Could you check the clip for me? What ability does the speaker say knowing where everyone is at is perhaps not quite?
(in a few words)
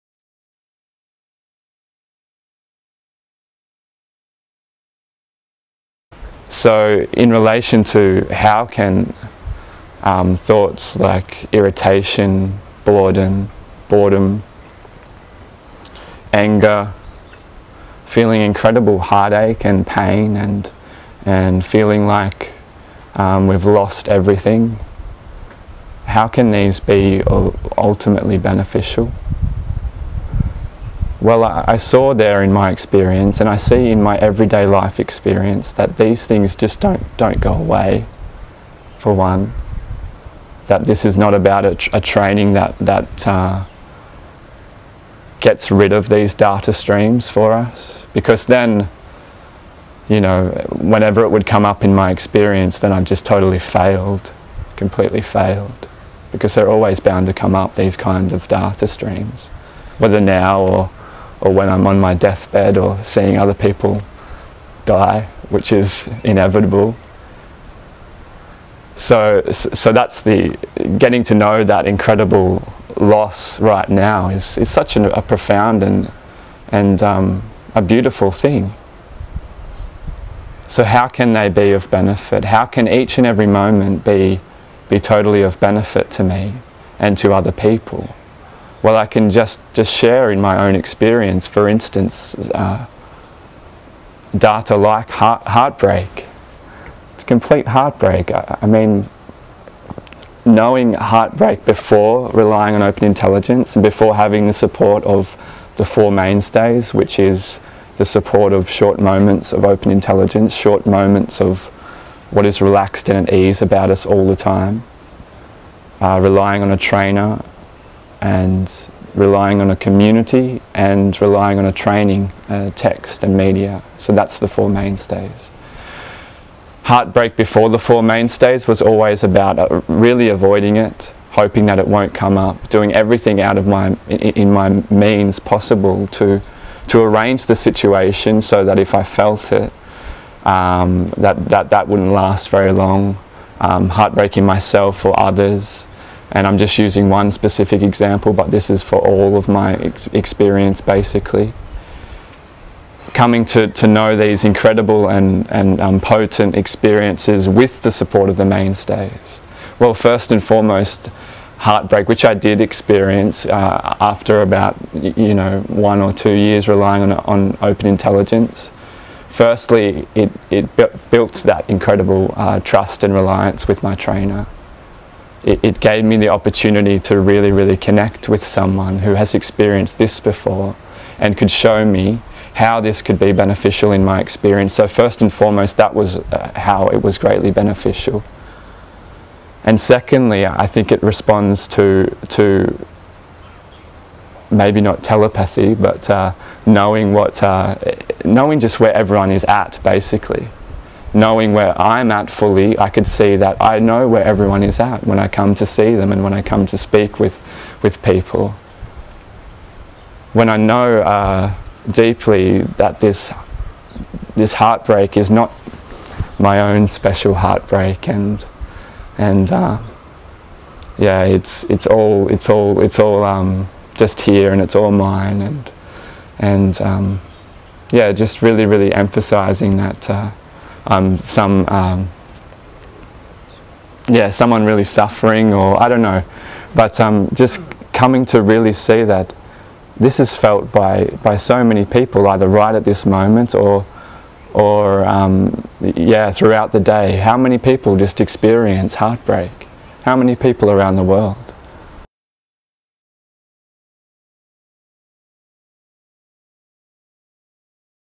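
Telepathy.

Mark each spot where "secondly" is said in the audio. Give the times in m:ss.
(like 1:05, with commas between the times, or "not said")
3:09.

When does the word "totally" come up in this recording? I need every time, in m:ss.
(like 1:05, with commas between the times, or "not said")
0:53, 1:24.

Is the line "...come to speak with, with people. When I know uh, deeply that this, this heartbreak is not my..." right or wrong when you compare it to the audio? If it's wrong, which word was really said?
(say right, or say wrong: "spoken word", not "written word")
right.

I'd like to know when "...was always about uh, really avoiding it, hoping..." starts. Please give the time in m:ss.
2:08.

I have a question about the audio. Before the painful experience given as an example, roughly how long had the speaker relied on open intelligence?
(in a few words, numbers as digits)
1 or 2 years.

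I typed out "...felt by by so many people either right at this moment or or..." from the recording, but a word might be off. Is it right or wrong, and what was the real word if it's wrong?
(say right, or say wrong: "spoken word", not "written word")
right.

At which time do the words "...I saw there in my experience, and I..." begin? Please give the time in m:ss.
0:31.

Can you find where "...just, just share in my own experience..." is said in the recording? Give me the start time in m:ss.
1:29.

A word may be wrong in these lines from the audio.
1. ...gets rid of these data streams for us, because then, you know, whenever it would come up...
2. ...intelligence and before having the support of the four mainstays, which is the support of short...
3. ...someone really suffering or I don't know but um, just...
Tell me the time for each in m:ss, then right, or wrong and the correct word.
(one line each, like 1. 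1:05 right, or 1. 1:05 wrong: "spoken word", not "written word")
1. 0:45 right
2. 1:43 right
3. 3:54 right.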